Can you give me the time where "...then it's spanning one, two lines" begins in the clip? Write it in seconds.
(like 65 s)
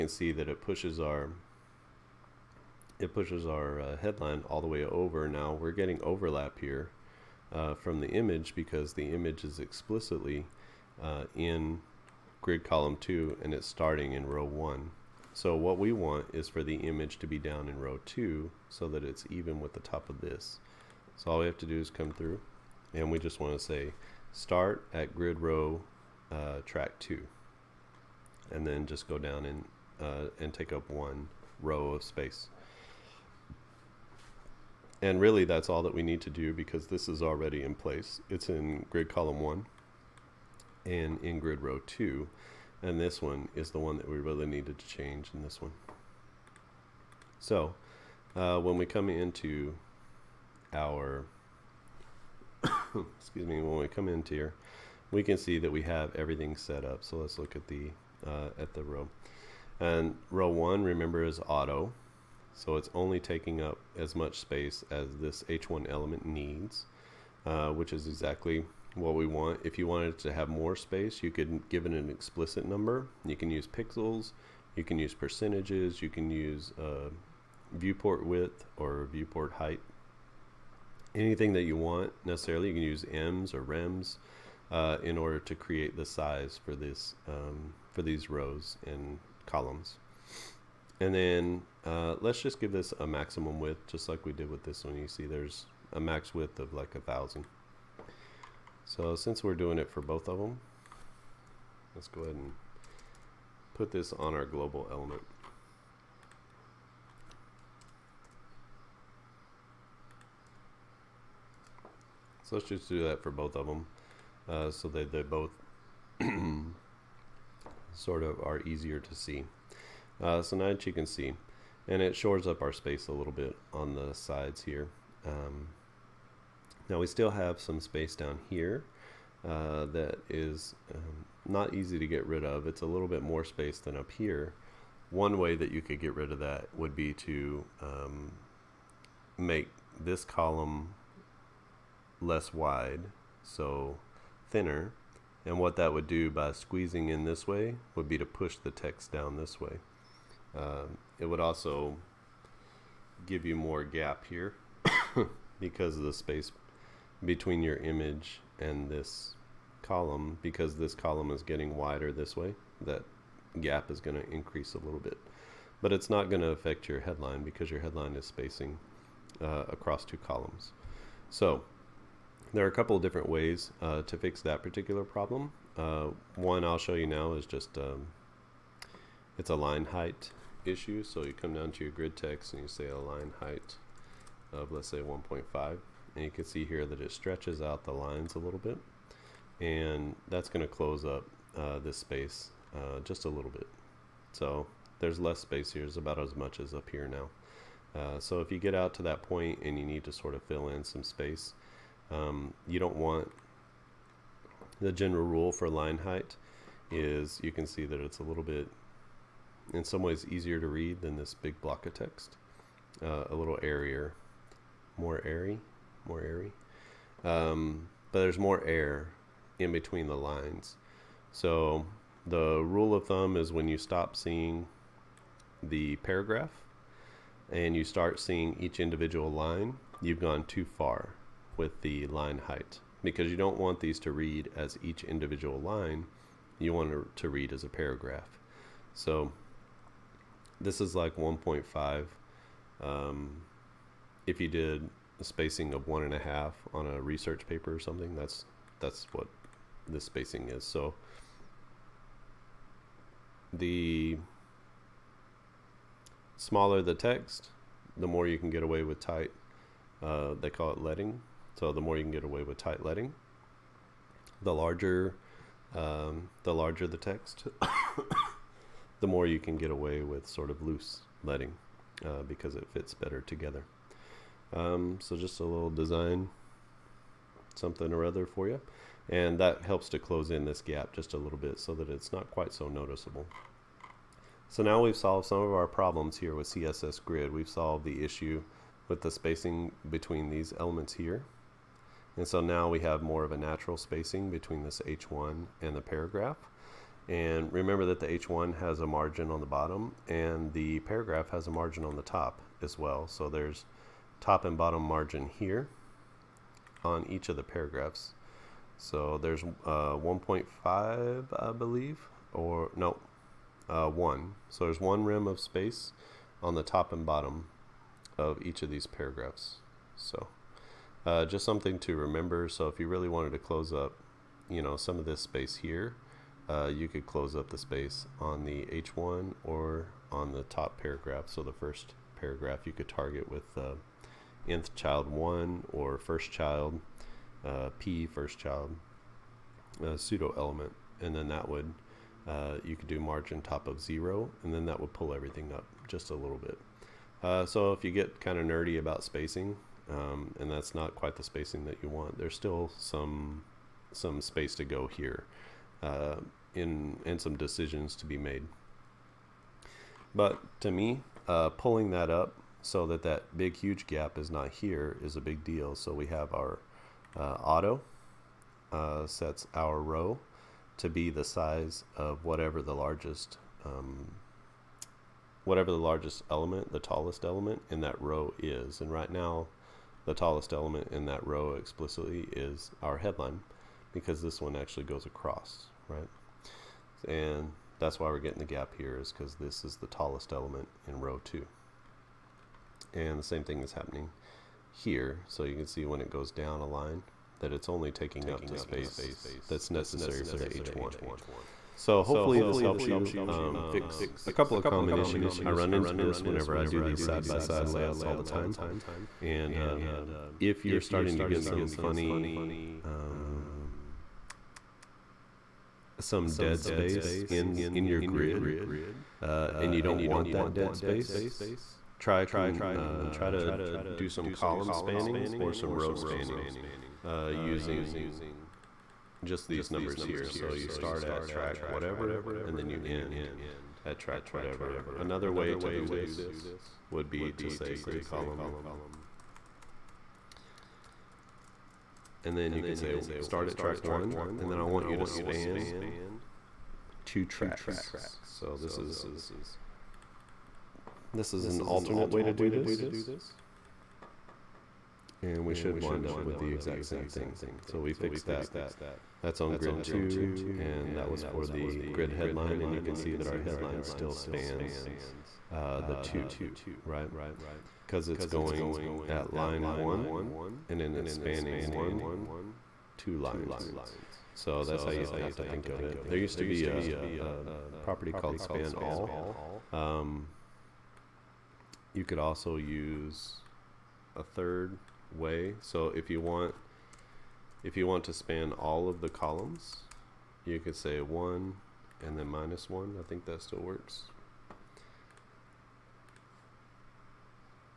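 470 s.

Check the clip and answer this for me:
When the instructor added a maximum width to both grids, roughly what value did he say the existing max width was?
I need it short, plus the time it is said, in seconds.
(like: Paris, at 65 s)
1000, at 96 s.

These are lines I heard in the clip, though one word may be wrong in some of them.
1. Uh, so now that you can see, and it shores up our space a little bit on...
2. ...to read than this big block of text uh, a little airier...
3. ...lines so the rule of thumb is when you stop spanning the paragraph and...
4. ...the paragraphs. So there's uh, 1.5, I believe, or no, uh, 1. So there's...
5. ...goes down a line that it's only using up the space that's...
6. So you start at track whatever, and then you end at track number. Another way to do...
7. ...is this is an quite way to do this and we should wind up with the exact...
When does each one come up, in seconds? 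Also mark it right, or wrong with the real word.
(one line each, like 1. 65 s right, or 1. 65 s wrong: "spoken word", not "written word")
1. 120 s right
2. 210 s right
3. 220 s wrong: "seeing", not "spanning"
4. 307 s right
5. 396 s wrong: "taking", not "using"
6. 430 s wrong: "whatever", not "number"
7. 448 s wrong: "alternate", not "quite".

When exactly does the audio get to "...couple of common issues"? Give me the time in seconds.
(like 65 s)
404 s.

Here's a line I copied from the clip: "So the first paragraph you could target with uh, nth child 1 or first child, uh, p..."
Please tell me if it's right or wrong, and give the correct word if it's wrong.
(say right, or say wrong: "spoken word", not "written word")
right.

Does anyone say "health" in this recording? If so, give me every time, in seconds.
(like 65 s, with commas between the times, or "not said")
not said.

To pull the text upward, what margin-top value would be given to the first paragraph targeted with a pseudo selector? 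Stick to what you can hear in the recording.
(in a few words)
0.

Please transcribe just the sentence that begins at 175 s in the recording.
Uh, one I'll show you now is just um, it's a line height issue.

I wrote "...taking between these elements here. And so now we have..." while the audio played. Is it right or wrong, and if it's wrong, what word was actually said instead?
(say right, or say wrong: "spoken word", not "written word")
wrong: "spacing", not "taking".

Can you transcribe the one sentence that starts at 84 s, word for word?
Uh, in order to create the size for this um, for these rows and columns.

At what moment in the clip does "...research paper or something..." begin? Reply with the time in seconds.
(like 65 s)
247 s.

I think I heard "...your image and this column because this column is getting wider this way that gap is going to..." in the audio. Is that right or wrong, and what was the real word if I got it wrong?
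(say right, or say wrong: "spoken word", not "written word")
right.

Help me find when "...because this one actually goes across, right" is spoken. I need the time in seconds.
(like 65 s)
383 s.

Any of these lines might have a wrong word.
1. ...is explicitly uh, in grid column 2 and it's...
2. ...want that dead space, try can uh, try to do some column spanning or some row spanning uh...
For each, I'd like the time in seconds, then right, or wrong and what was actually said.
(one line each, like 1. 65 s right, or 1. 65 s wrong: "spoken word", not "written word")
1. 9 s right
2. 420 s right.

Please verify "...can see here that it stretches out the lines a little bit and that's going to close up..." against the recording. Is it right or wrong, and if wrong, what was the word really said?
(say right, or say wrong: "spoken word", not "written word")
right.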